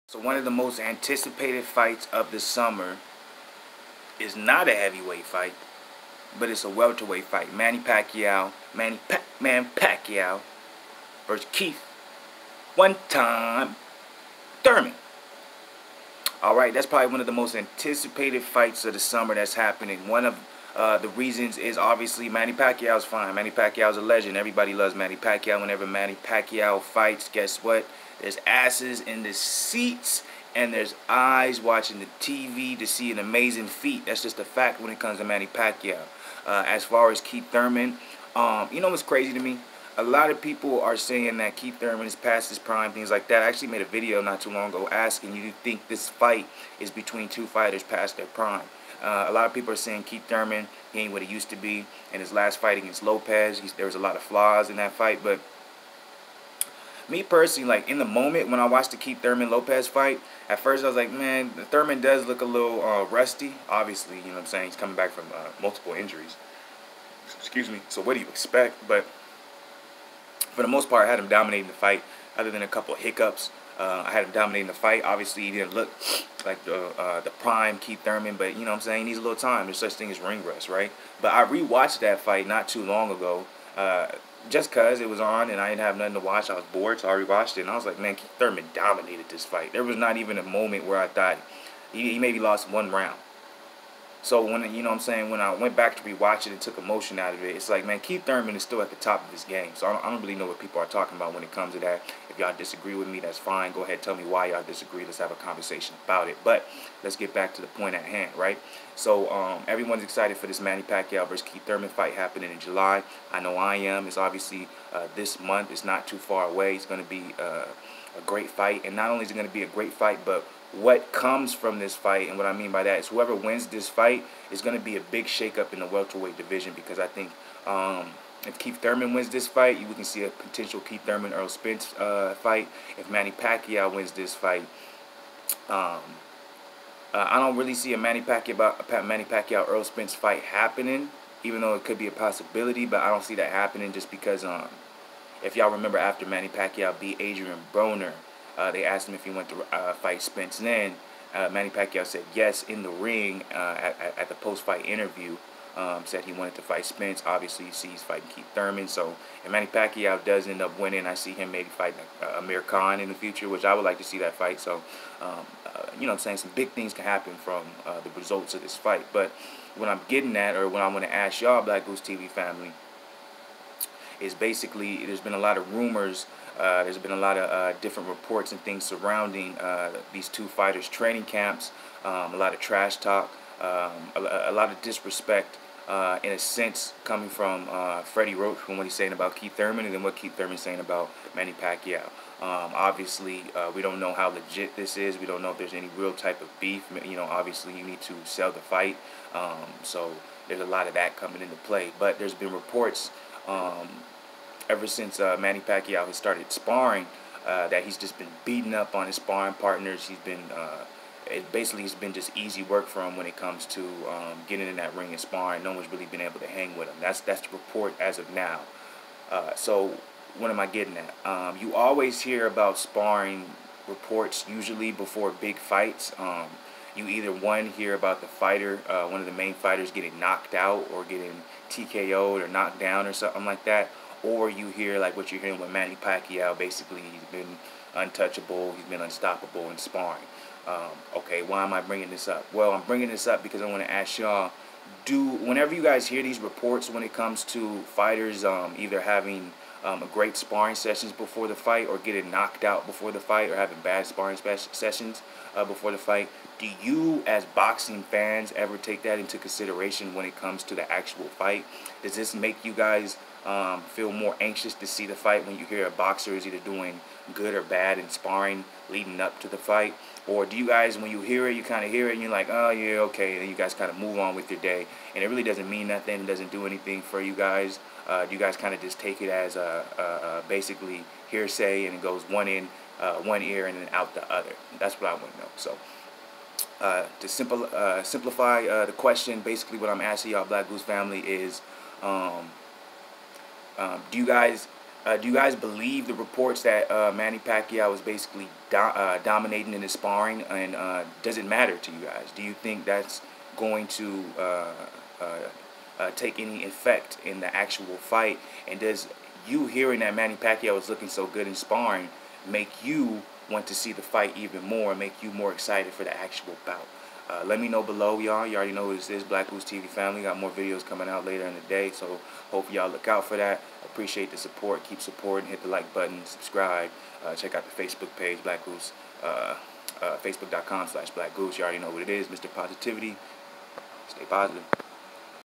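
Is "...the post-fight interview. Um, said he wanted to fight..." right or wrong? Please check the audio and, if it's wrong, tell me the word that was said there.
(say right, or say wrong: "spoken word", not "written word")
right.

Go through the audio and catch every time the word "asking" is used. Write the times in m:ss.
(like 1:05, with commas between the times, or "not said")
0:44, 4:50.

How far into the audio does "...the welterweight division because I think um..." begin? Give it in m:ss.
2:05.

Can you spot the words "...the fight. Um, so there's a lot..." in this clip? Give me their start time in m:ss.
3:18.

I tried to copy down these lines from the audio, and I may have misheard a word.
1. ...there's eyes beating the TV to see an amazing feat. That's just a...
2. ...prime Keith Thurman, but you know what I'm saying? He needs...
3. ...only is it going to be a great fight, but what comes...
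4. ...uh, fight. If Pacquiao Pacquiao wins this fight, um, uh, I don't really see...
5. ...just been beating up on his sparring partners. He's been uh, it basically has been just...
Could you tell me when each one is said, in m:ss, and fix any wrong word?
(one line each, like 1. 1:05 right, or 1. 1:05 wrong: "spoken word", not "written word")
1. 0:30 wrong: "watching", not "beating"
2. 1:17 right
3. 1:59 right
4. 2:11 wrong: "Manny", not "Pacquiao"
5. 3:27 right.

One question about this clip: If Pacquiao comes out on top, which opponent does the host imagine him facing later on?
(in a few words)
Amir Khan.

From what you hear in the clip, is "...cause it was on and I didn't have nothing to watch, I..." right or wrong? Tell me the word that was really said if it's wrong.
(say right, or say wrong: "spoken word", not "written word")
right.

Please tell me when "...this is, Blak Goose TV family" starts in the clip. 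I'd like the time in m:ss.
5:18.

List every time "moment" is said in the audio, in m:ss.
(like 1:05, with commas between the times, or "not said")
0:58, 1:30.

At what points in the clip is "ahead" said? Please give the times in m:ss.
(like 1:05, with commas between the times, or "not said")
1:43.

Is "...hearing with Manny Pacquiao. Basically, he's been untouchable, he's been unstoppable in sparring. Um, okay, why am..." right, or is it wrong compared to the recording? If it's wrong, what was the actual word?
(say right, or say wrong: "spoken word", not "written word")
right.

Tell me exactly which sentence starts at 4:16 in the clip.
Do you, as boxing fans, ever take that into consideration when it comes to the actual fight?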